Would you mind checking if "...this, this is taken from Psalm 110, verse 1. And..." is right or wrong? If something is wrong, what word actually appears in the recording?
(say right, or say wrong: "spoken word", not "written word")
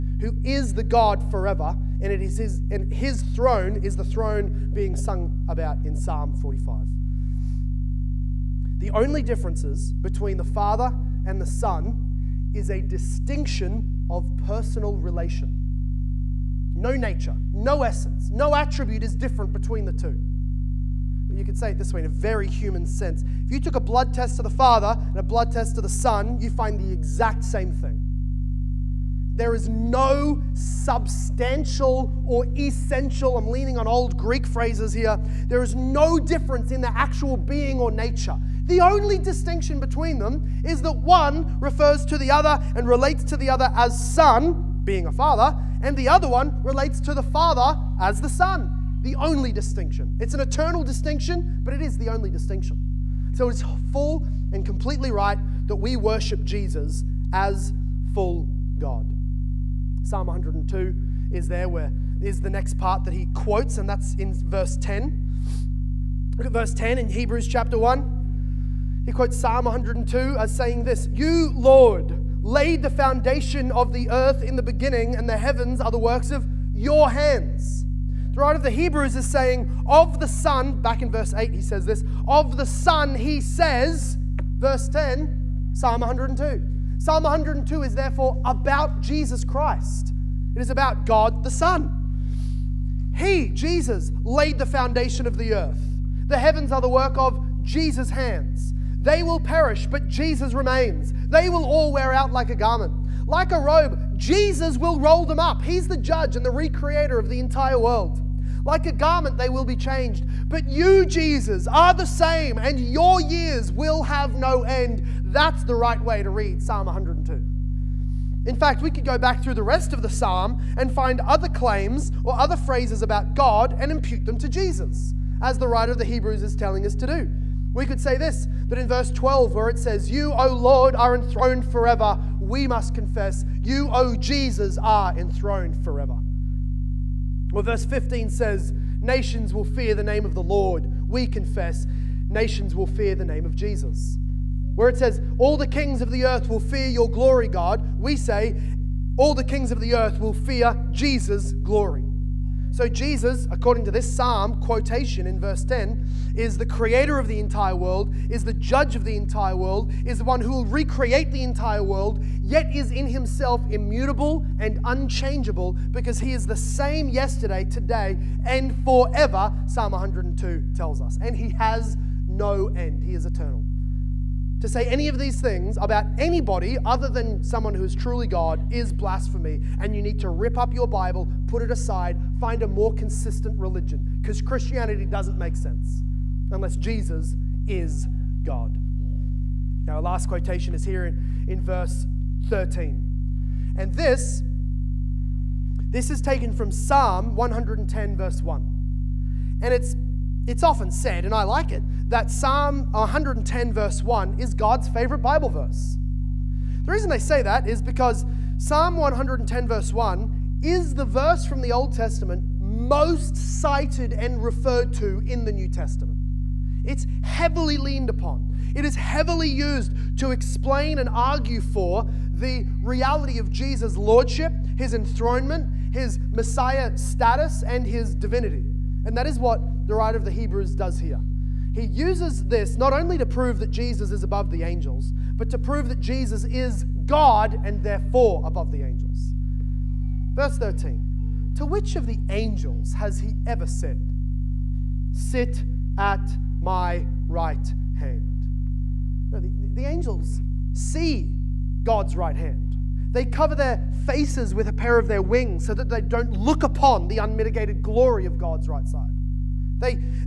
right.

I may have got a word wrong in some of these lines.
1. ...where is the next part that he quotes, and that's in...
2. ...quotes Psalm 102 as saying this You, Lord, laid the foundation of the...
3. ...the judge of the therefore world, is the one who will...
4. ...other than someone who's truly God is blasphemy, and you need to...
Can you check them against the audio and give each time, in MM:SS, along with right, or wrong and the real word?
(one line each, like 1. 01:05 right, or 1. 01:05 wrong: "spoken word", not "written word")
1. 01:01 right
2. 01:09 right
3. 02:38 wrong: "entire", not "therefore"
4. 02:56 right.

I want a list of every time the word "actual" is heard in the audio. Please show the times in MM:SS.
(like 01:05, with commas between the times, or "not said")
00:36.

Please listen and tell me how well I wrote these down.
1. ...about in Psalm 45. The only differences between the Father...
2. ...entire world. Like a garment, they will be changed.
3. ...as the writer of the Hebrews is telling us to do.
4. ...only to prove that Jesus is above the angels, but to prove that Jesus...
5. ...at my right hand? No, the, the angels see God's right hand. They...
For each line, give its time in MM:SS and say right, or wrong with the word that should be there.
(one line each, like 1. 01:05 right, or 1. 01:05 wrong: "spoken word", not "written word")
1. 00:05 right
2. 01:47 right
3. 02:05 right
4. 03:52 right
5. 04:05 right.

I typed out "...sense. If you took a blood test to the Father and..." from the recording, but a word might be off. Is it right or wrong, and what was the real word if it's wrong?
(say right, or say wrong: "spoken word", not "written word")
right.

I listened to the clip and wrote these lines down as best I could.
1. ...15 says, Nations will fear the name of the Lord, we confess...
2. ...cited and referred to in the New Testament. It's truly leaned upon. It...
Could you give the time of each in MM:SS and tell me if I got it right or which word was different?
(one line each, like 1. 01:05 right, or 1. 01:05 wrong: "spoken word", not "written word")
1. 02:17 right
2. 03:33 wrong: "heavily", not "truly".